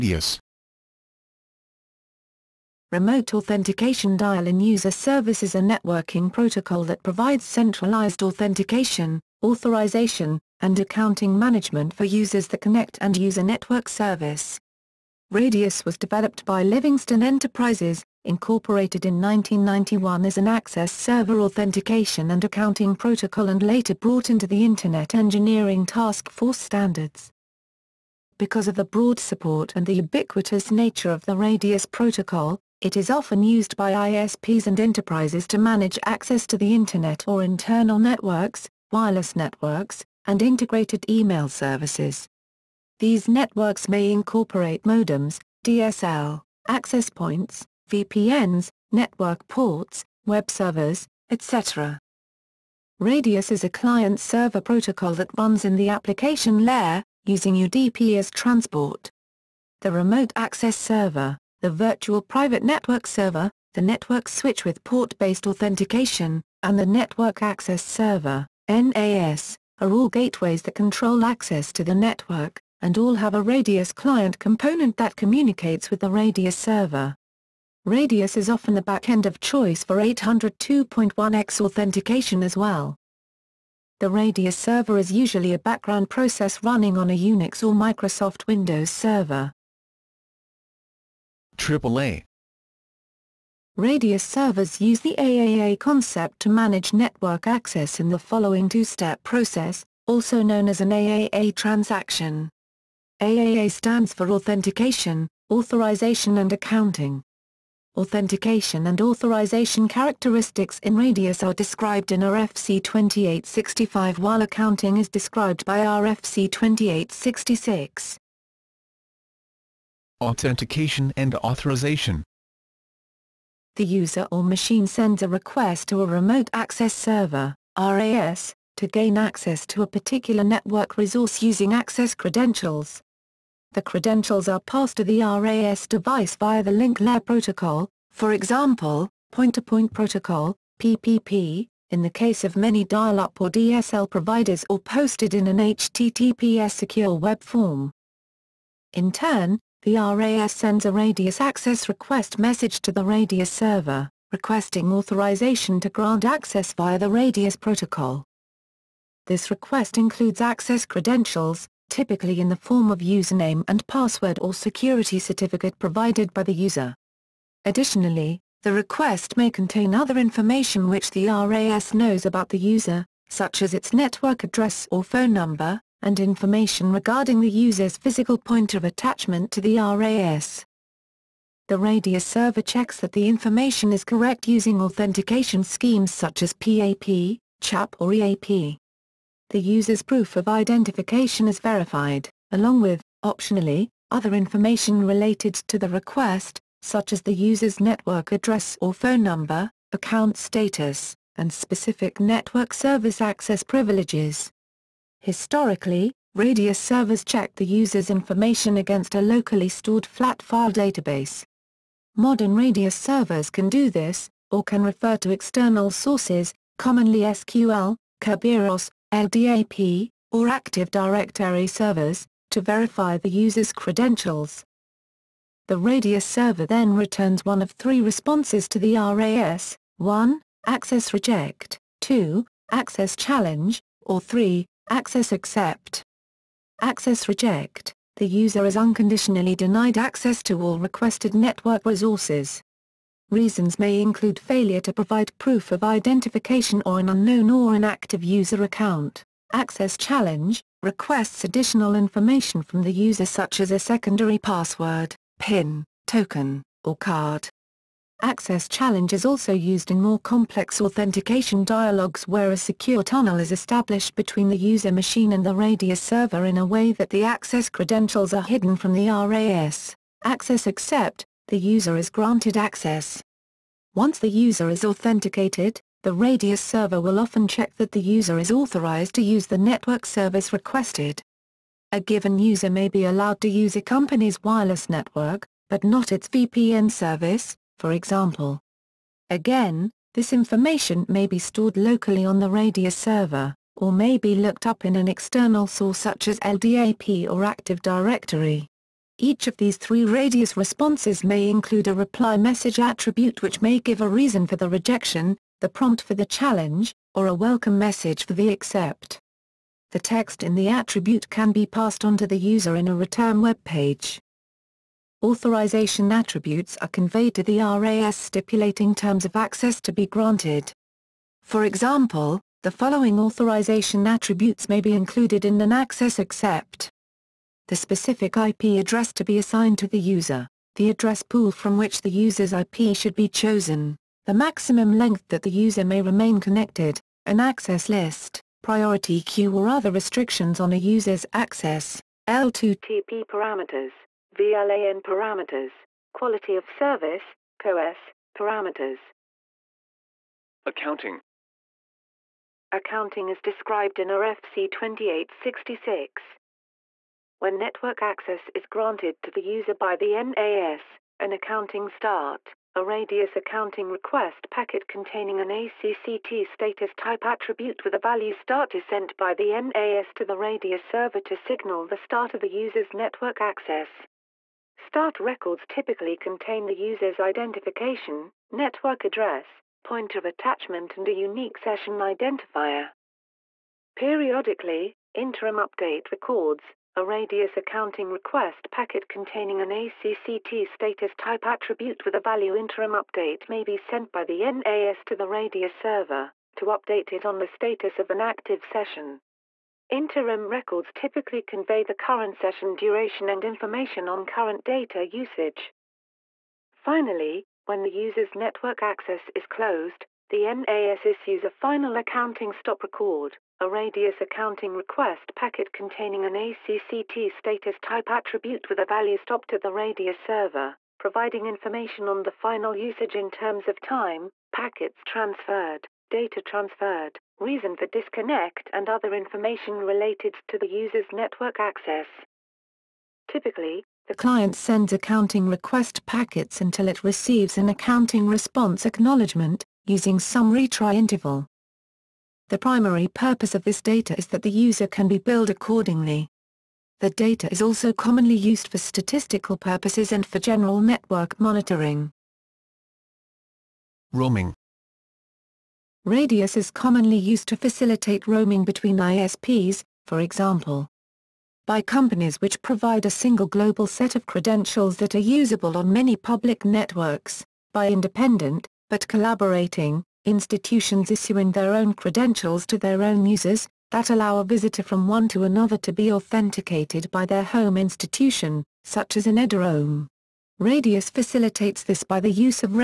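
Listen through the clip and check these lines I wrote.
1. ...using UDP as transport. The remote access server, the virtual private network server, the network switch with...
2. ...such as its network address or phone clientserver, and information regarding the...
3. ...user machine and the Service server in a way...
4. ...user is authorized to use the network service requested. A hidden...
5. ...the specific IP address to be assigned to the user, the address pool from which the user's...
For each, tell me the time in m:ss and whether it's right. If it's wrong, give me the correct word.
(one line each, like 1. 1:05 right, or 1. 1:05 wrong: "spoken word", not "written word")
1. 0:57 right
2. 2:53 wrong: "number", not "clientserver"
3. 4:24 wrong: "RADIUS", not "Service"
4. 4:38 wrong: "given", not "hidden"
5. 5:27 right.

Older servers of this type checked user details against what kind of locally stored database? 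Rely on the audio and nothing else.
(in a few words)
flat file database.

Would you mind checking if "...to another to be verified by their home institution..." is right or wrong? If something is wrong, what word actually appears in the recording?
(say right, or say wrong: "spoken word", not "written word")
wrong: "authenticated", not "verified".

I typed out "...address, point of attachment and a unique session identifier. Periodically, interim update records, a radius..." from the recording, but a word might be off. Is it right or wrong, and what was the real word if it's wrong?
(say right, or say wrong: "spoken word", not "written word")
right.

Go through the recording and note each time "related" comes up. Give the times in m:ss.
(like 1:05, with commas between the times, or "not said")
3:15, 7:09.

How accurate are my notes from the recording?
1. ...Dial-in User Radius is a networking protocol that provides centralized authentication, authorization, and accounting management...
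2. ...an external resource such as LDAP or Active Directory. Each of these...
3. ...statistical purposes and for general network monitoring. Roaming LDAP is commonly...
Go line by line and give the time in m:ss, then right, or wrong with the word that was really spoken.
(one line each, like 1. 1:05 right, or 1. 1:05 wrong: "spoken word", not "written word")
1. 0:04 wrong: "Service", not "Radius"
2. 4:54 wrong: "source", not "resource"
3. 7:28 wrong: "Radius", not "LDAP".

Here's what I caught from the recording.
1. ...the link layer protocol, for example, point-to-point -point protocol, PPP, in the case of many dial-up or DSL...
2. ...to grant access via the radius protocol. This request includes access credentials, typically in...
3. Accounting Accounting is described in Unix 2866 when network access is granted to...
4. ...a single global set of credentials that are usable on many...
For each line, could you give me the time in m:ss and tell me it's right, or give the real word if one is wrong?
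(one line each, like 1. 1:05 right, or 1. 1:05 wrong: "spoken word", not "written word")
1. 2:16 right
2. 2:35 right
3. 5:50 wrong: "RFC", not "Unix"
4. 7:43 right.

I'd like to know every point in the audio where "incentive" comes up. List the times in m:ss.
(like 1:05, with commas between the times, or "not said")
not said.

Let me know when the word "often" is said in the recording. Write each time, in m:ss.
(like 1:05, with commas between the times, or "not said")
0:33, 1:18, 4:37.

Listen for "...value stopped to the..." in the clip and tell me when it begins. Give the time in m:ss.
6:58.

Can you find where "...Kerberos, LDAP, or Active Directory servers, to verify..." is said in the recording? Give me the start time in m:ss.
3:38.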